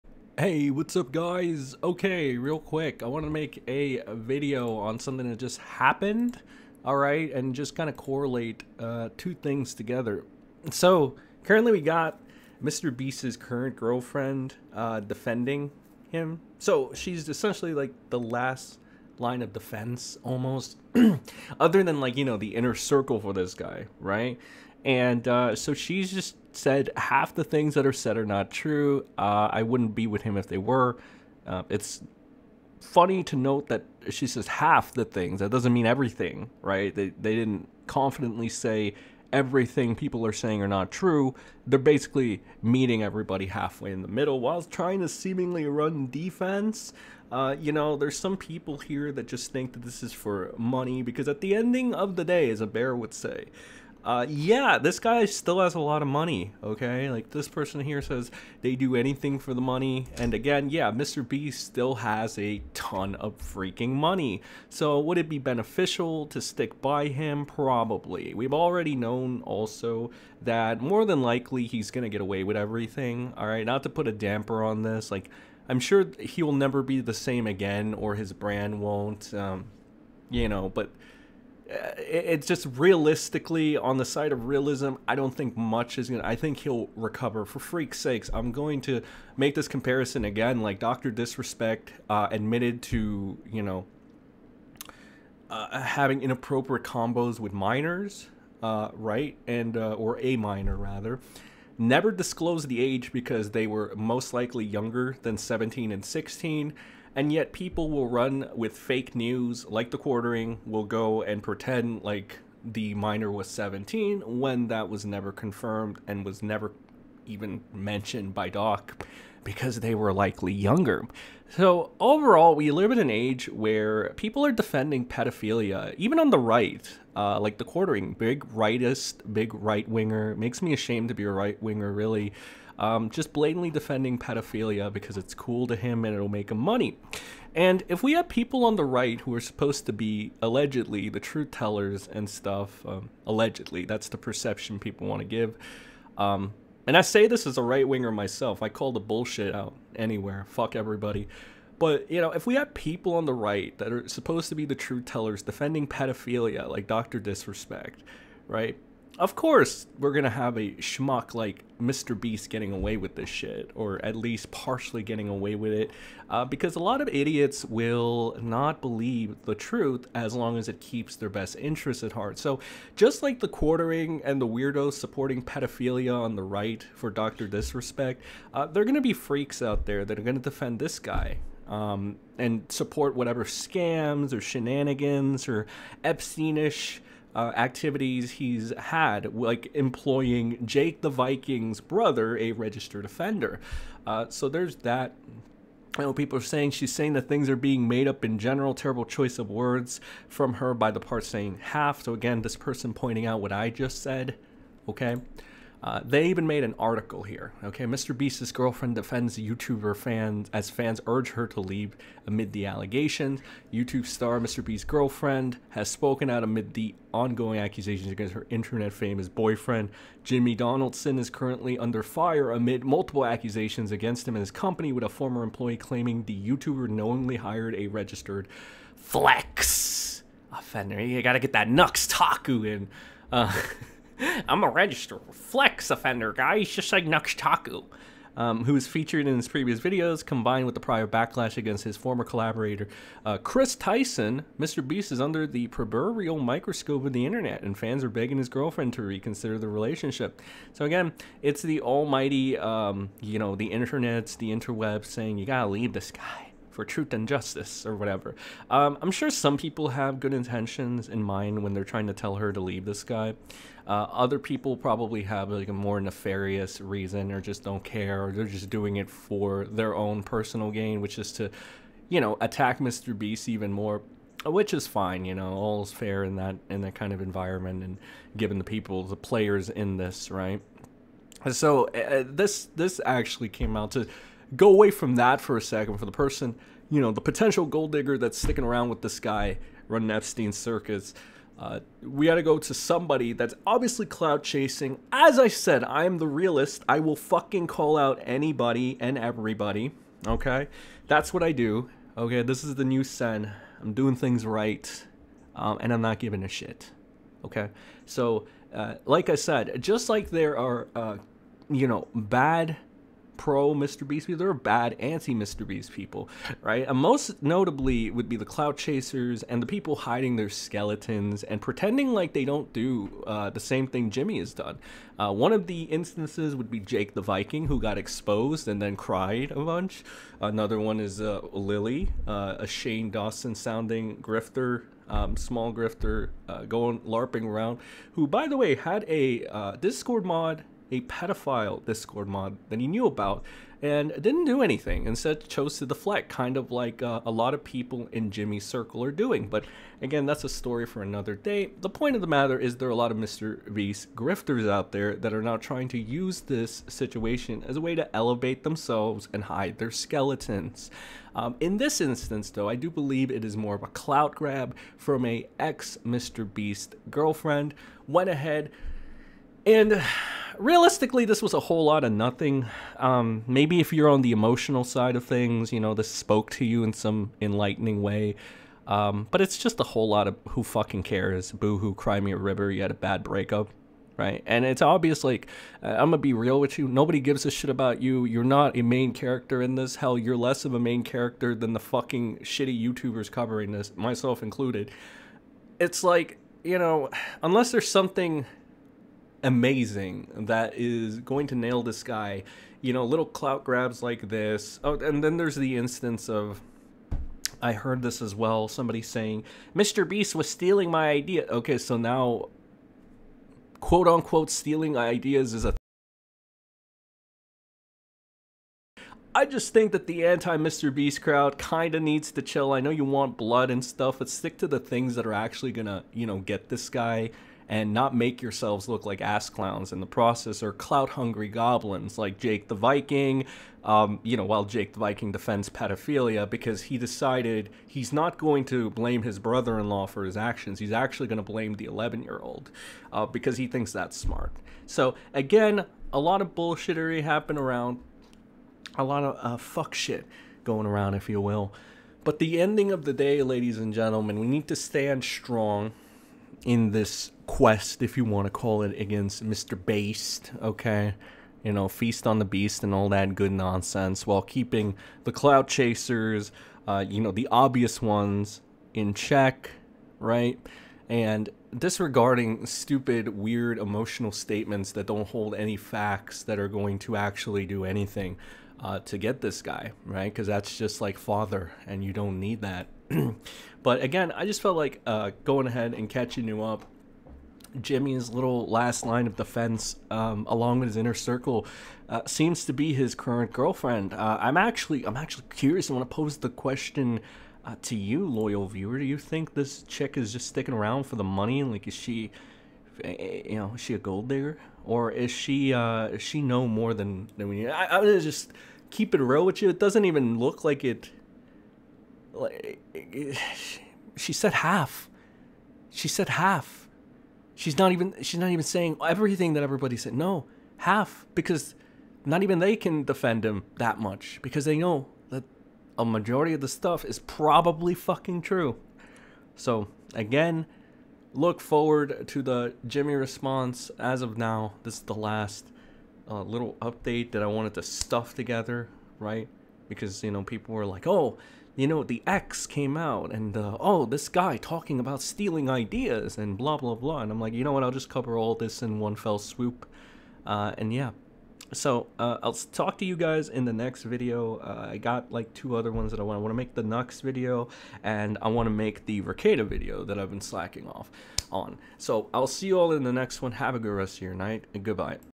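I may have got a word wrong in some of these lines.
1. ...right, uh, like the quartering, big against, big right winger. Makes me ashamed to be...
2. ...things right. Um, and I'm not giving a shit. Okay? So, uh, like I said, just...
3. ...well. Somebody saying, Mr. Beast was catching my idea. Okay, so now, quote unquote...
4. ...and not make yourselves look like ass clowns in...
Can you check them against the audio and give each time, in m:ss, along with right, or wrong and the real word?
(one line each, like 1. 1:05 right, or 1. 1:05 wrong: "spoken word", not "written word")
1. 2:06 wrong: "rightist", not "against"
2. 5:04 right
3. 6:48 wrong: "stealing", not "catching"
4. 7:07 right.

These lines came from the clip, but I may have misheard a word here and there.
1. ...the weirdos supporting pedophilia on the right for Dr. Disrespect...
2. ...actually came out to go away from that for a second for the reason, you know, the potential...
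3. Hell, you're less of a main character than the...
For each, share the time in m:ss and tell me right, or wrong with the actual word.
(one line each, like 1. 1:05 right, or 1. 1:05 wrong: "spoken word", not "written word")
1. 2:54 right
2. 4:43 wrong: "person", not "reason"
3. 6:29 right.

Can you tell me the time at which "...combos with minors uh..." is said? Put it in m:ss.
1:36.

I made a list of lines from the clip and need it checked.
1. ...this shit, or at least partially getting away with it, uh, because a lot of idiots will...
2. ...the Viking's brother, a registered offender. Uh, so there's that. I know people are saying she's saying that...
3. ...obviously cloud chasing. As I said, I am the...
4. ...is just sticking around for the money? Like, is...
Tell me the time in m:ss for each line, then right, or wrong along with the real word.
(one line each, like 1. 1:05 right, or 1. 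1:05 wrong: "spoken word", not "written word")
1. 2:43 right
2. 3:11 right
3. 4:53 right
4. 8:20 right.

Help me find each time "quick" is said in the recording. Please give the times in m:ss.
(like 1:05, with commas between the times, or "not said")
0:02.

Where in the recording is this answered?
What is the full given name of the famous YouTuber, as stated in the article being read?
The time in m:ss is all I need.
3:40.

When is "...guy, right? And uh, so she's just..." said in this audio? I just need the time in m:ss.
0:23.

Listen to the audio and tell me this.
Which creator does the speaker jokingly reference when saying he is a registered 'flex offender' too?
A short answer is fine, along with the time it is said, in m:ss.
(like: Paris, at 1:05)
Nuxtaku, at 3:57.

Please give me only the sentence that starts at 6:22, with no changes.
You had a bad breakup, right?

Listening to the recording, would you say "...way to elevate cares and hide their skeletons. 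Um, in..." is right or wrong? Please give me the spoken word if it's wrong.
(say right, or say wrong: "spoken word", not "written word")
wrong: "themselves", not "cares".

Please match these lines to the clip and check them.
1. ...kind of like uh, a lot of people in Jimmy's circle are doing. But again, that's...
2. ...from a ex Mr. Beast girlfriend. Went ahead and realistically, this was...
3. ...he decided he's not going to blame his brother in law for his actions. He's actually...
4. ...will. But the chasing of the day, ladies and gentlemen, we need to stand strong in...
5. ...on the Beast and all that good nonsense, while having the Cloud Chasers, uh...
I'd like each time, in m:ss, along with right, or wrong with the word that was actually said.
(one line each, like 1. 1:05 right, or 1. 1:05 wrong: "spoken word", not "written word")
1. 5:46 right
2. 6:04 right
3. 7:16 right
4. 7:31 wrong: "ending", not "chasing"
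5. 7:42 wrong: "keeping", not "having".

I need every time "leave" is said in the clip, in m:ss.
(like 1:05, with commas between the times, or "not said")
3:31, 4:15, 4:22.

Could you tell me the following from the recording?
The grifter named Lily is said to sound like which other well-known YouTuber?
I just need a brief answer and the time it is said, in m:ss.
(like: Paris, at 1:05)
Shane Dawson, at 5:32.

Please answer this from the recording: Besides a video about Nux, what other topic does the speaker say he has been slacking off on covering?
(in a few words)
Verkada.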